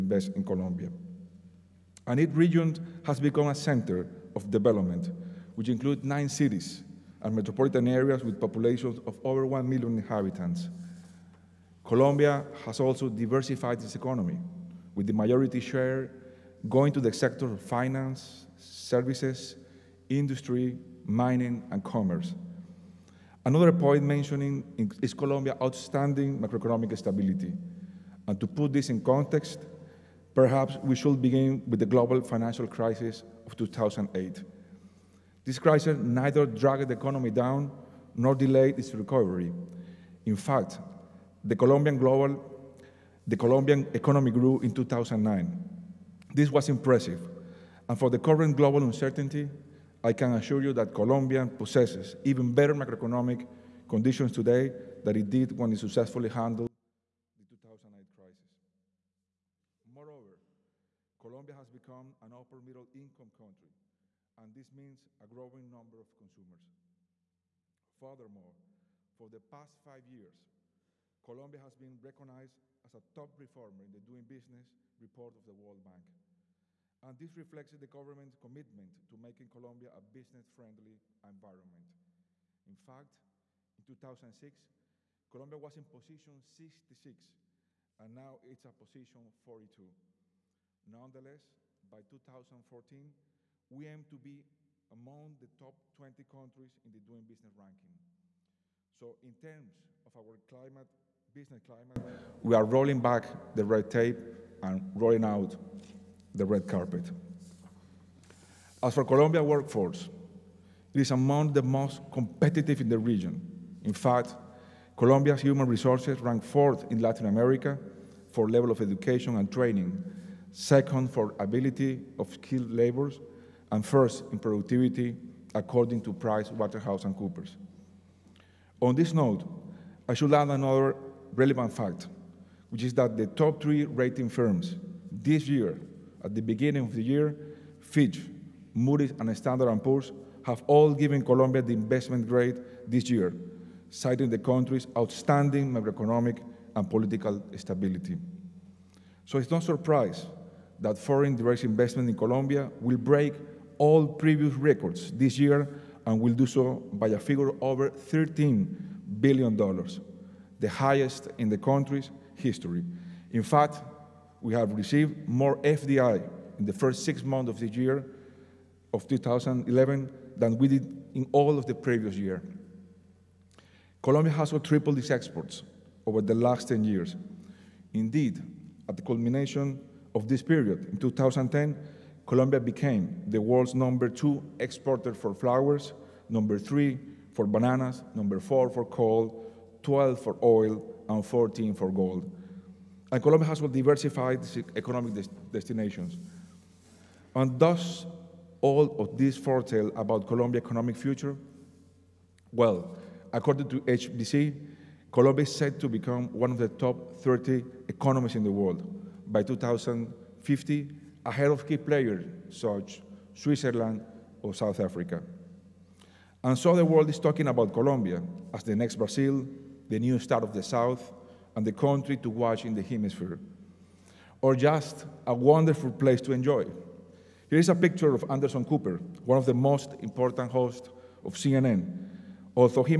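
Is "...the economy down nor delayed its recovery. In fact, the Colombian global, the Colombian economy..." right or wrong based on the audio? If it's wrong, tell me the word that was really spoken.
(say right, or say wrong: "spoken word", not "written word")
right.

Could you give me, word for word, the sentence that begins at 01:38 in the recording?
So in terms of our climate, business climate, we are rolling back the red tape and rolling out the red carpet.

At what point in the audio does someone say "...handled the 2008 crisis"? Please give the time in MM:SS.
00:56.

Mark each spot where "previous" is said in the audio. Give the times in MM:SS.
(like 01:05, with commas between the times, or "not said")
02:34, 02:51.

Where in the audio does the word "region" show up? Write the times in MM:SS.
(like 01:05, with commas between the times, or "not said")
00:02, 01:52.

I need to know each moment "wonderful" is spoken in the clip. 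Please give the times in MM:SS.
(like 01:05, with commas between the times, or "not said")
03:45.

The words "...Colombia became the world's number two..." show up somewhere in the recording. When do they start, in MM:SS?
03:02.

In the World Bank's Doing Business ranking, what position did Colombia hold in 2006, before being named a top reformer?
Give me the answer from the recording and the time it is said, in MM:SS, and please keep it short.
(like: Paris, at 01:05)
66, at 01:25.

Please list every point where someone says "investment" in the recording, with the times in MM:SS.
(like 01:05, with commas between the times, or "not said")
02:21, 02:31.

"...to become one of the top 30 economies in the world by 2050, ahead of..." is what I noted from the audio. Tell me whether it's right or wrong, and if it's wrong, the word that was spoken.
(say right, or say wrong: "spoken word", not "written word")
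right.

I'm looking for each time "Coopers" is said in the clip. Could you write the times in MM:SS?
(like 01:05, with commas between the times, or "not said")
02:07, 03:48.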